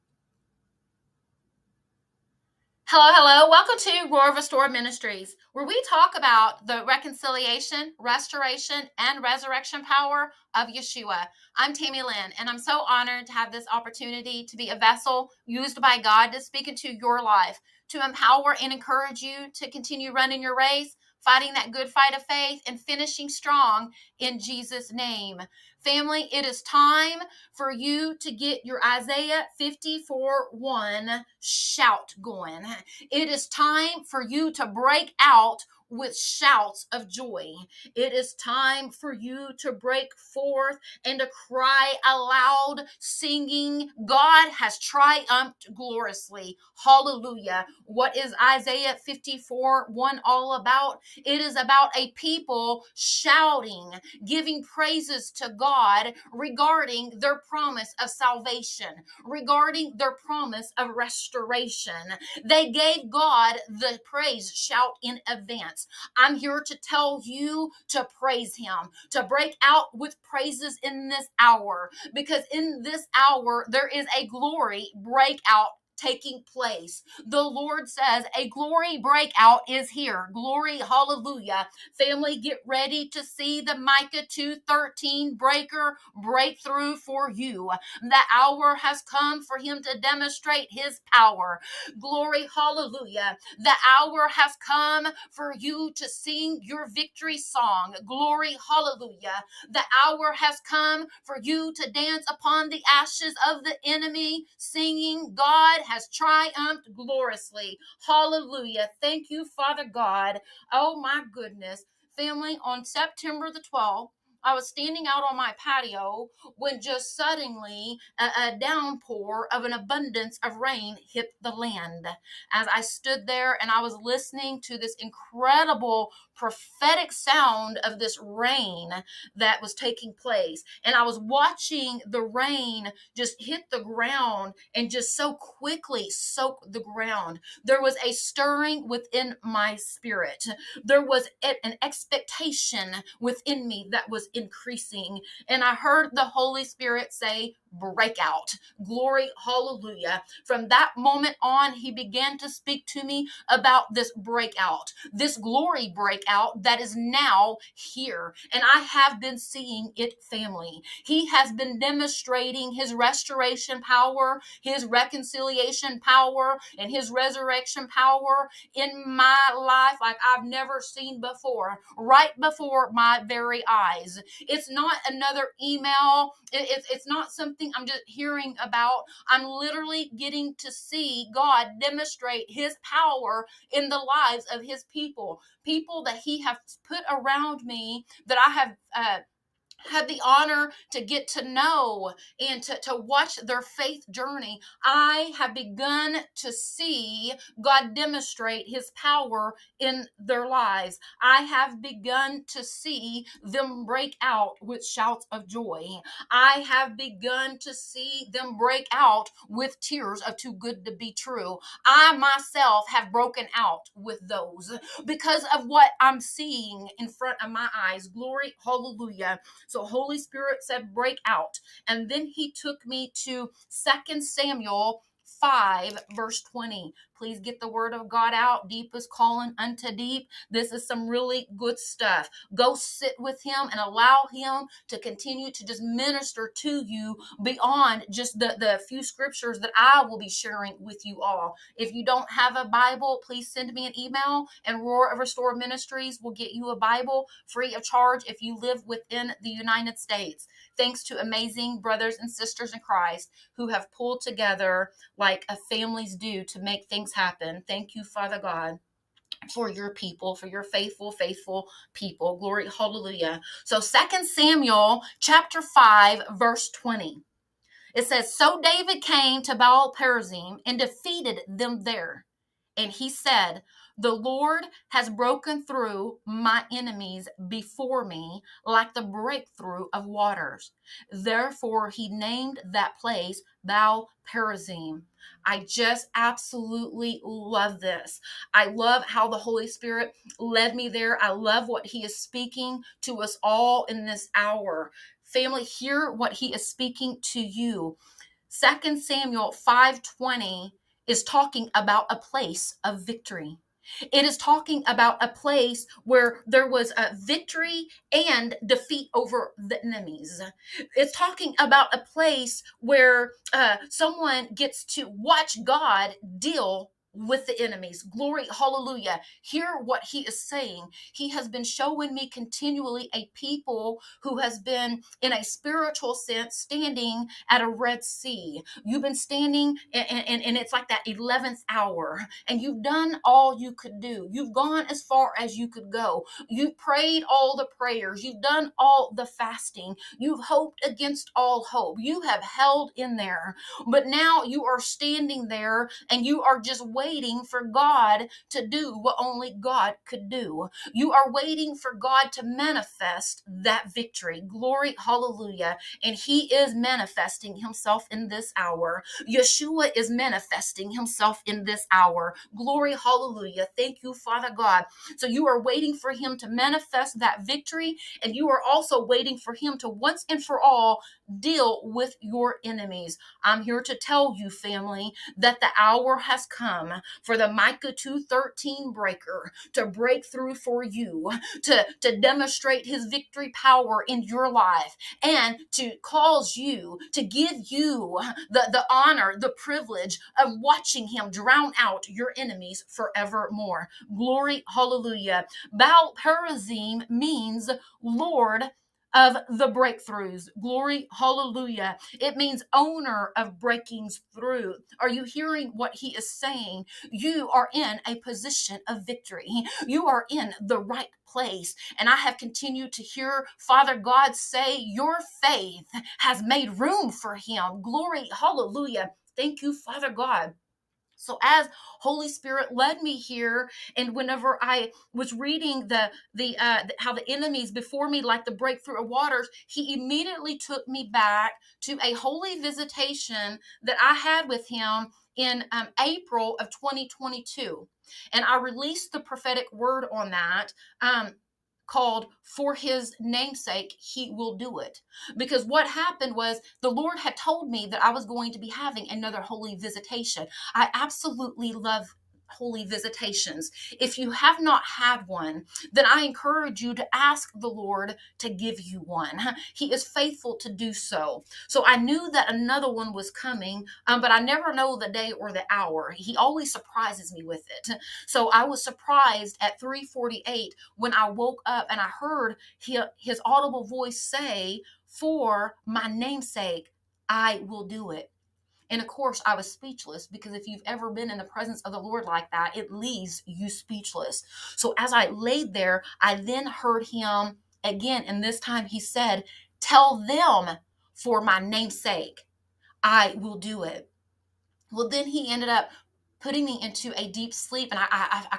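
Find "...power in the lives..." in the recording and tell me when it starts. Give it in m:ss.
3:02.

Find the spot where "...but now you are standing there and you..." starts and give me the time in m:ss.
5:43.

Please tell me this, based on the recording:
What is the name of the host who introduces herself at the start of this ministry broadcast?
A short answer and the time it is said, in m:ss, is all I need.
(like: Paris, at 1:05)
Tammy Lynn, at 0:11.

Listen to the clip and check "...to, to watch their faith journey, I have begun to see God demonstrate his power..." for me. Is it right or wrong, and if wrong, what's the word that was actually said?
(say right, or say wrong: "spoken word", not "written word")
right.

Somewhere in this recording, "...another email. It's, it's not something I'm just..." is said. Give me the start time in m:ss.
2:55.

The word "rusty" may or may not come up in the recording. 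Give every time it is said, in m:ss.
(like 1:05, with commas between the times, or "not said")
not said.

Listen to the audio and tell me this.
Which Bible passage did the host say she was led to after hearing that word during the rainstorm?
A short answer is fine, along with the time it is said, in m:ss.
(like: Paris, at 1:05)
2 Samuel 5:20, at 3:43.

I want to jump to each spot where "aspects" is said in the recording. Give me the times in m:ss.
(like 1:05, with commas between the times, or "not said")
not said.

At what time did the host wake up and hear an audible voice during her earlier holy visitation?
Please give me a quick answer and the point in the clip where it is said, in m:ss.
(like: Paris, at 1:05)
3:48, at 7:49.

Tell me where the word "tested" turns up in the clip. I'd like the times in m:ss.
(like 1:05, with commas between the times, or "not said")
not said.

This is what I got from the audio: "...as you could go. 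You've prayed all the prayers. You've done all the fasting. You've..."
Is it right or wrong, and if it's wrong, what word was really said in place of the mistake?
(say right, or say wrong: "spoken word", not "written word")
right.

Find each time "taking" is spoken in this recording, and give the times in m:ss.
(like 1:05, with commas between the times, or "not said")
1:15, 2:09.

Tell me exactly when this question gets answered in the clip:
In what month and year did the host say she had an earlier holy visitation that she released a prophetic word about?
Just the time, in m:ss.
7:15.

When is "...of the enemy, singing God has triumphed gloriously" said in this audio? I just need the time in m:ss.
1:43.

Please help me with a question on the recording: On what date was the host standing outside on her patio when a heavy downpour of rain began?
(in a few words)
September 12.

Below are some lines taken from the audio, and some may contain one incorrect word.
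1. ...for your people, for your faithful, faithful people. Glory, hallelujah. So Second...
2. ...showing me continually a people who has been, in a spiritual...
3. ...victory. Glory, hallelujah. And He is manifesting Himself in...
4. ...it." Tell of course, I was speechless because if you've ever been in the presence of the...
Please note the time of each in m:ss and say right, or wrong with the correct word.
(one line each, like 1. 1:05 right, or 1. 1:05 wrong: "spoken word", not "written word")
1. 4:19 right
2. 5:21 right
3. 5:53 right
4. 7:58 wrong: "And", not "Tell".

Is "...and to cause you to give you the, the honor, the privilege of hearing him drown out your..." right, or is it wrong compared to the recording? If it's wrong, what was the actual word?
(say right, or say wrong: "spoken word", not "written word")
wrong: "watching", not "hearing".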